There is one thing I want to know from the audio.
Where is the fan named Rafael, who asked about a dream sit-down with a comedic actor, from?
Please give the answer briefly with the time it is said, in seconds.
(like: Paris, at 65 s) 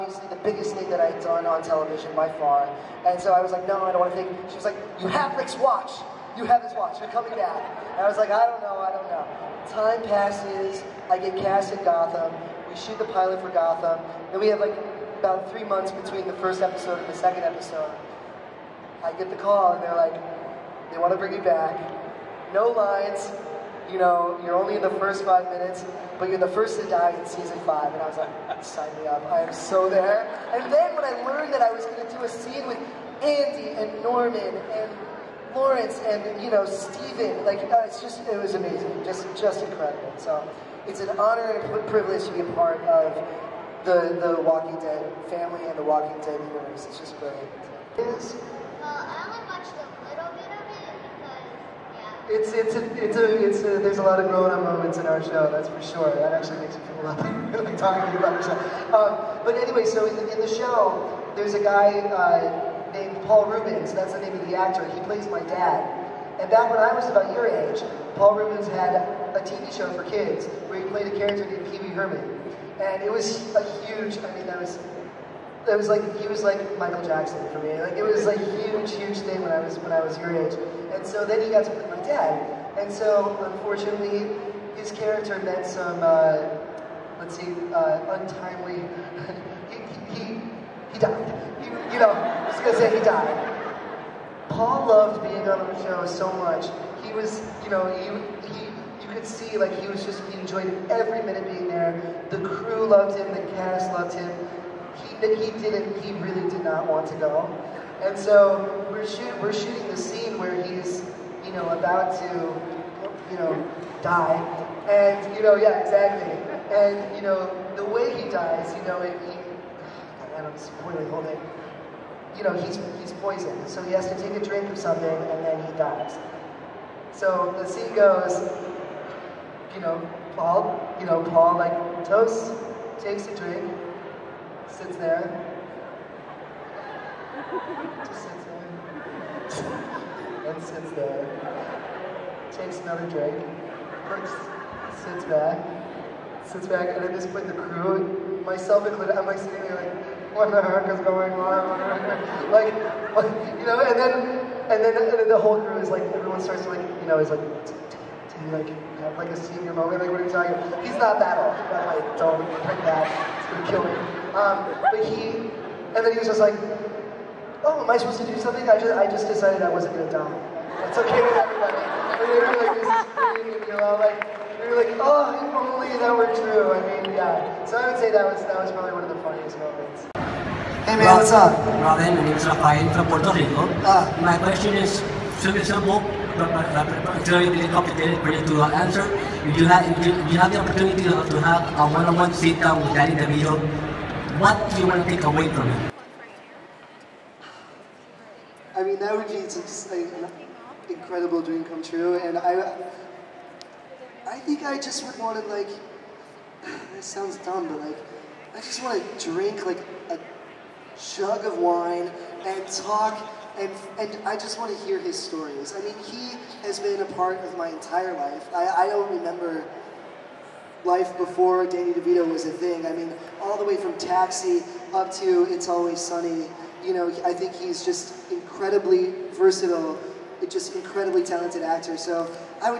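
Puerto Rico, at 183 s.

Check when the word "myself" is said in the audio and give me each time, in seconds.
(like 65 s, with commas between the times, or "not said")
148 s.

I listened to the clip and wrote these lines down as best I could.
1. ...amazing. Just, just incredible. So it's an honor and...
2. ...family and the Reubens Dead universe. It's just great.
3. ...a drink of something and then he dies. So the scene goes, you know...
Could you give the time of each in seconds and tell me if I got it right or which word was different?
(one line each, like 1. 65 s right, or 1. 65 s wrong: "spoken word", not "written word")
1. 38 s right
2. 45 s wrong: "Walking", not "Reubens"
3. 124 s right.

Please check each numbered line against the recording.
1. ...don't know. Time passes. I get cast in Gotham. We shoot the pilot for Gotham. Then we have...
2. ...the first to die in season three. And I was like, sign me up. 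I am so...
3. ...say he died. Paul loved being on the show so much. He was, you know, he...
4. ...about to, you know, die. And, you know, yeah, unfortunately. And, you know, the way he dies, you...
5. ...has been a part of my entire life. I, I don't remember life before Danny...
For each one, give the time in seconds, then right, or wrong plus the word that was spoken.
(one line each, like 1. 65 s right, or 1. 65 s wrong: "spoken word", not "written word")
1. 8 s right
2. 26 s wrong: "five", not "three"
3. 92 s right
4. 111 s wrong: "exactly", not "unfortunately"
5. 216 s right.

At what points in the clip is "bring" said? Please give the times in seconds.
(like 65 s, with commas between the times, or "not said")
21 s, 162 s.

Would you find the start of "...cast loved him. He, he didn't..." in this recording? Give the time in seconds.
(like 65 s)
103 s.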